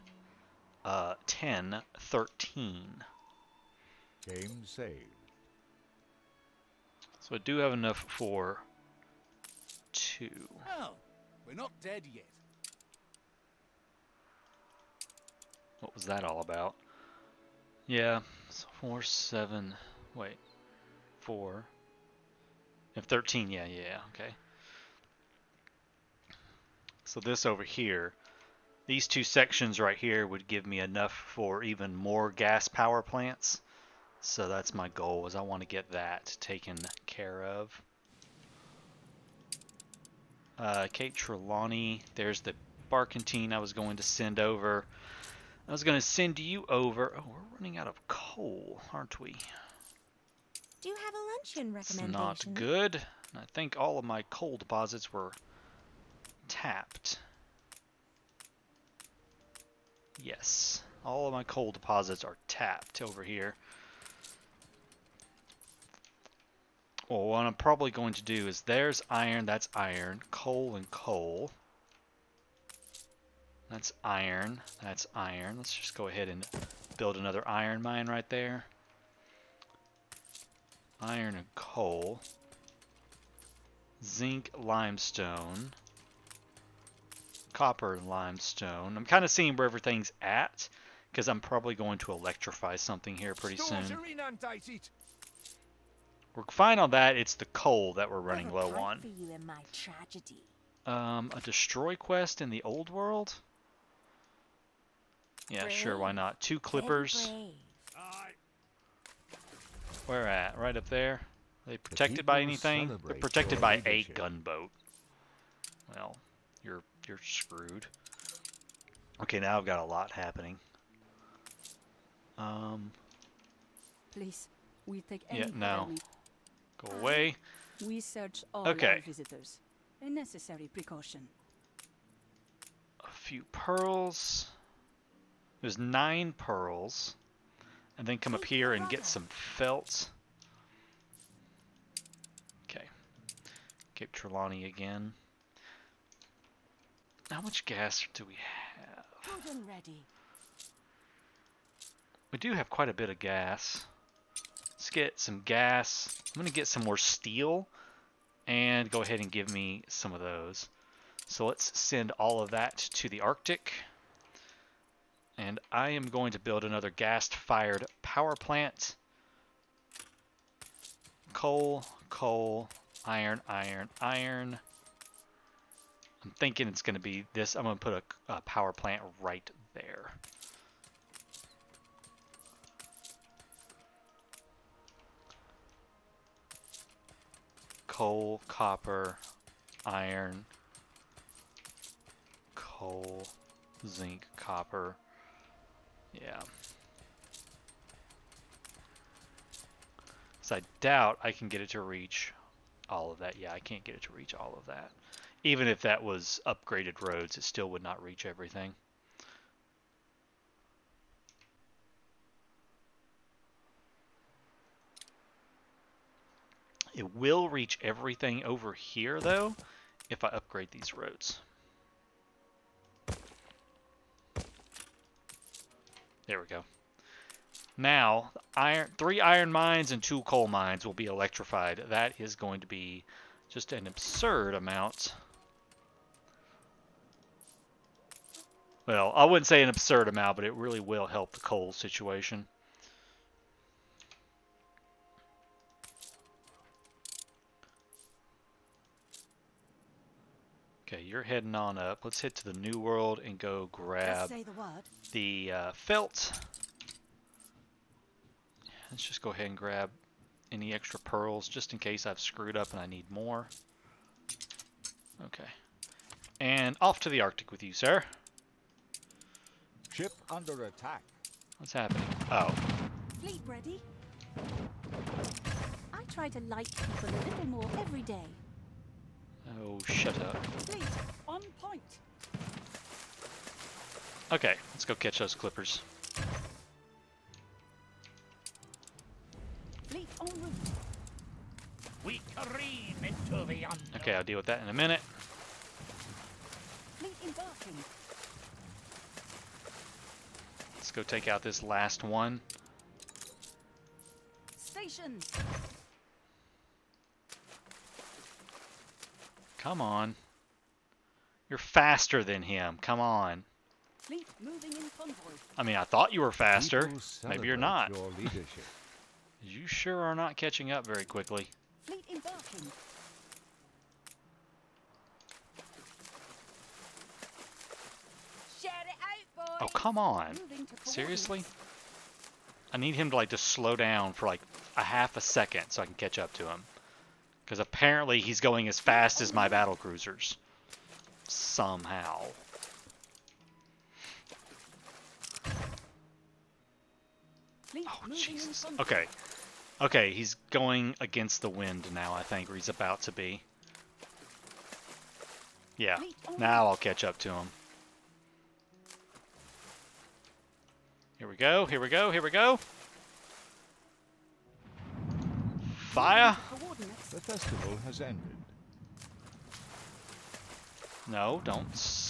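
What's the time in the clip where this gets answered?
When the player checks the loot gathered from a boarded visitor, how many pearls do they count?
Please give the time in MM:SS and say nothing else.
02:15.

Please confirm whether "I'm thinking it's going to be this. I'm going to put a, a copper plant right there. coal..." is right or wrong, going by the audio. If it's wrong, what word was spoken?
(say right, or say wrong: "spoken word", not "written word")
wrong: "power", not "copper".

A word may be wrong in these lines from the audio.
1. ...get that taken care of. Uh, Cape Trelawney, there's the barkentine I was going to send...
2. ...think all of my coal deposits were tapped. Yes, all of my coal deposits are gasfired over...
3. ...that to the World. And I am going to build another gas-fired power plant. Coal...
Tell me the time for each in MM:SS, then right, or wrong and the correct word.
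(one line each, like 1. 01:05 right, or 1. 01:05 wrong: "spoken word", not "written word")
1. 00:35 right
2. 00:53 wrong: "tapped", not "gasfired"
3. 02:42 wrong: "Arctic", not "World".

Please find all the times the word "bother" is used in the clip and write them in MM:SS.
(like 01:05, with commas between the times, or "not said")
not said.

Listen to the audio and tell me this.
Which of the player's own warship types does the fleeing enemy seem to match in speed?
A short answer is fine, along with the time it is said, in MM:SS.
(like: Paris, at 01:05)
Battle cruisers, at 05:39.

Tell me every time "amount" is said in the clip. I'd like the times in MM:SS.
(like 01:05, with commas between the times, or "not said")
03:54, 04:00.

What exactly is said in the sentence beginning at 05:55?
Yeah, oh, now I'll catch up to him.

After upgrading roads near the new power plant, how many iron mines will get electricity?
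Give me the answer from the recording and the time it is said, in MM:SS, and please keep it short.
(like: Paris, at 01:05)
3, at 03:48.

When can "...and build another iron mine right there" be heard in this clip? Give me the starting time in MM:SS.
01:16.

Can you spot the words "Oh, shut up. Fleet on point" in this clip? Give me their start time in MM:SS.
04:39.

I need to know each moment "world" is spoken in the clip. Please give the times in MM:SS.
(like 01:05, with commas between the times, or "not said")
01:42, 04:12.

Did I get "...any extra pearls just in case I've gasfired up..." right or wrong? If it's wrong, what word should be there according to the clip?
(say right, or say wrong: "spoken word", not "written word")
wrong: "screwed", not "gasfired".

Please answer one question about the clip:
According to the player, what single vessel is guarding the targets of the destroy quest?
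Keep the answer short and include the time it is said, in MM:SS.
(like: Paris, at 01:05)
A gunboat, at 01:54.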